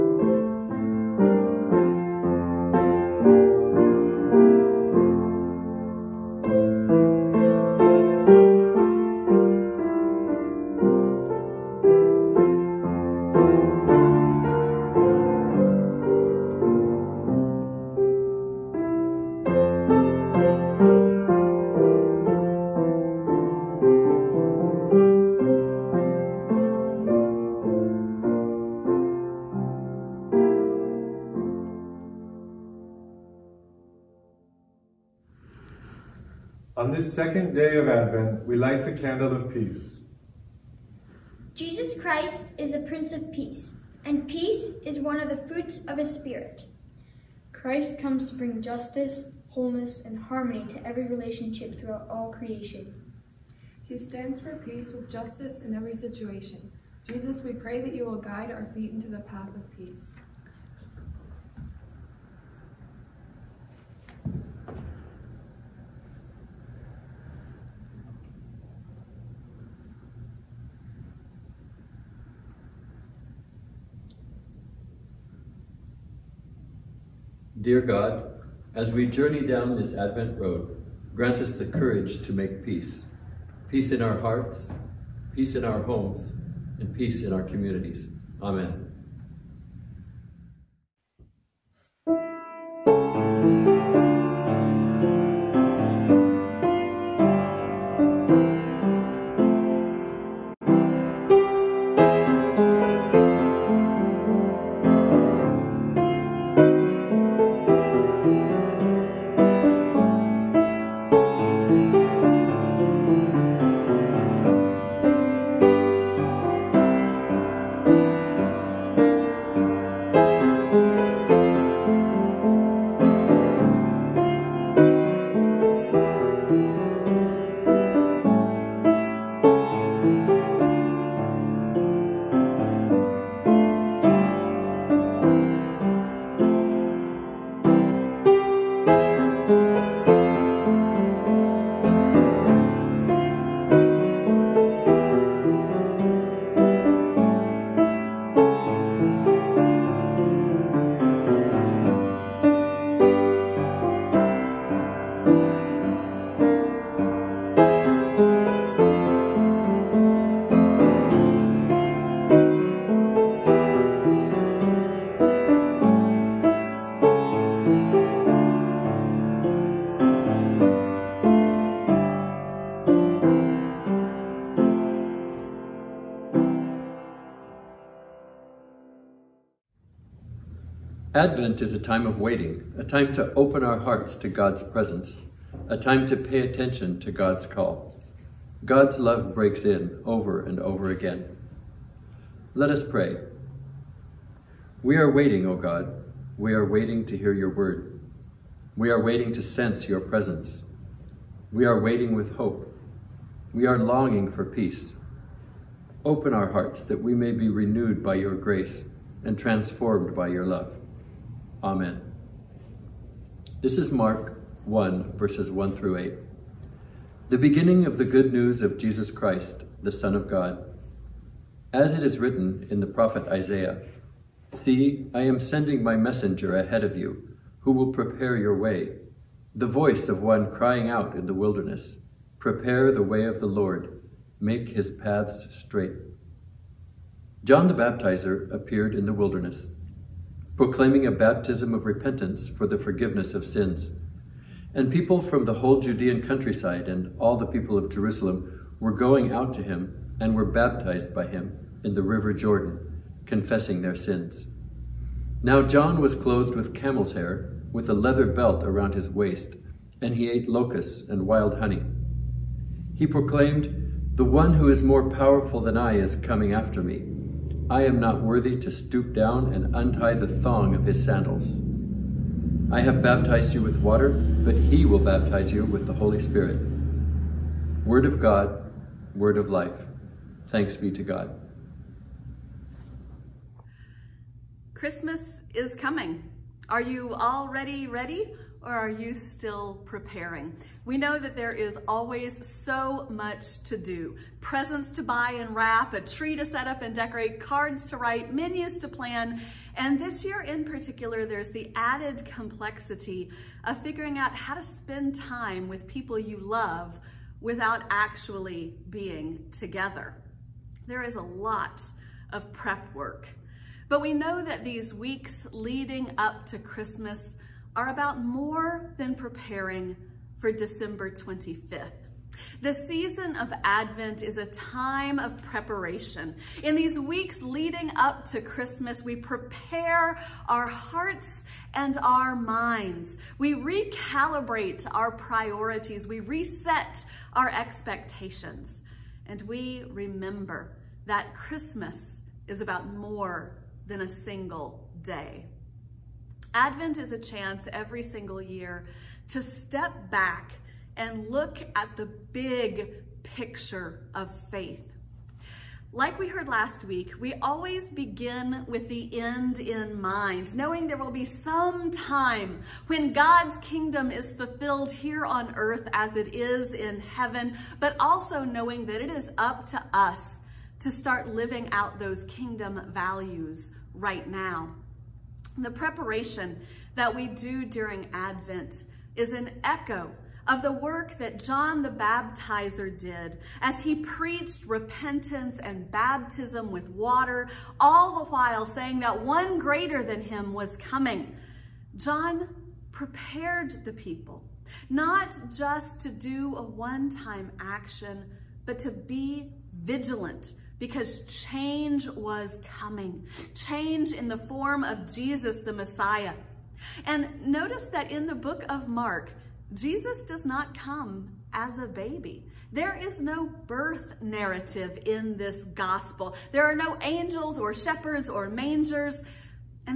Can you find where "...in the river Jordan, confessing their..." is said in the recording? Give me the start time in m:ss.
4:11.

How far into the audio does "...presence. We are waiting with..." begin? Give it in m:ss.
3:20.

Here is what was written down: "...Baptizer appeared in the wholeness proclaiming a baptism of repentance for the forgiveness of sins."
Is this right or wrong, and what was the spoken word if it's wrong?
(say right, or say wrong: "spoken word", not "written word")
wrong: "wilderness", not "wholeness".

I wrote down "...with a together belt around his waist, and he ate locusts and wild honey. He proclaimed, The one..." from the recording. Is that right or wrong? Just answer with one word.
wrong.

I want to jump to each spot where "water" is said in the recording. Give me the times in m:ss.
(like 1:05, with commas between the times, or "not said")
4:33, 6:26.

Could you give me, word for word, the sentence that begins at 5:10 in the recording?
There is a lot of prep work.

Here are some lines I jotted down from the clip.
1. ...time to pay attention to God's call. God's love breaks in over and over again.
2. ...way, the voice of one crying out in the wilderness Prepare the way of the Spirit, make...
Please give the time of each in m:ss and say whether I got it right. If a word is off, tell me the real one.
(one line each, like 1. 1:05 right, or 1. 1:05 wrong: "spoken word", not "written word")
1. 3:05 right
2. 3:48 wrong: "Lord", not "Spirit".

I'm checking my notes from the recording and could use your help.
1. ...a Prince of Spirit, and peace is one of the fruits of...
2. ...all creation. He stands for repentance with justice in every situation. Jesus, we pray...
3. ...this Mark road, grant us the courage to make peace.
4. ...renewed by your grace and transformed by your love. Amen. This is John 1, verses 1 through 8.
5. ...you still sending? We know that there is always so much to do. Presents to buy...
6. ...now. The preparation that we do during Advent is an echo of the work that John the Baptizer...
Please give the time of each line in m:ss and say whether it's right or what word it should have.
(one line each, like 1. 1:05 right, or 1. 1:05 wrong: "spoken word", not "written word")
1. 0:42 wrong: "Peace", not "Spirit"
2. 0:52 wrong: "peace", not "repentance"
3. 1:19 wrong: "Advent", not "Mark"
4. 3:27 wrong: "Mark", not "John"
5. 4:48 wrong: "preparing", not "sending"
6. 6:14 right.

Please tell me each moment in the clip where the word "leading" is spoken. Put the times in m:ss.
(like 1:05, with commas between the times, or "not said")
5:15, 5:27.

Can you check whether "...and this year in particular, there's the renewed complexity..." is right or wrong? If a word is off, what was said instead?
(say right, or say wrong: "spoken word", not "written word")
wrong: "added", not "renewed".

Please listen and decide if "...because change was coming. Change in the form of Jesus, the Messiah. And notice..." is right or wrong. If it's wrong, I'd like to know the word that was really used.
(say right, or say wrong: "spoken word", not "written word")
right.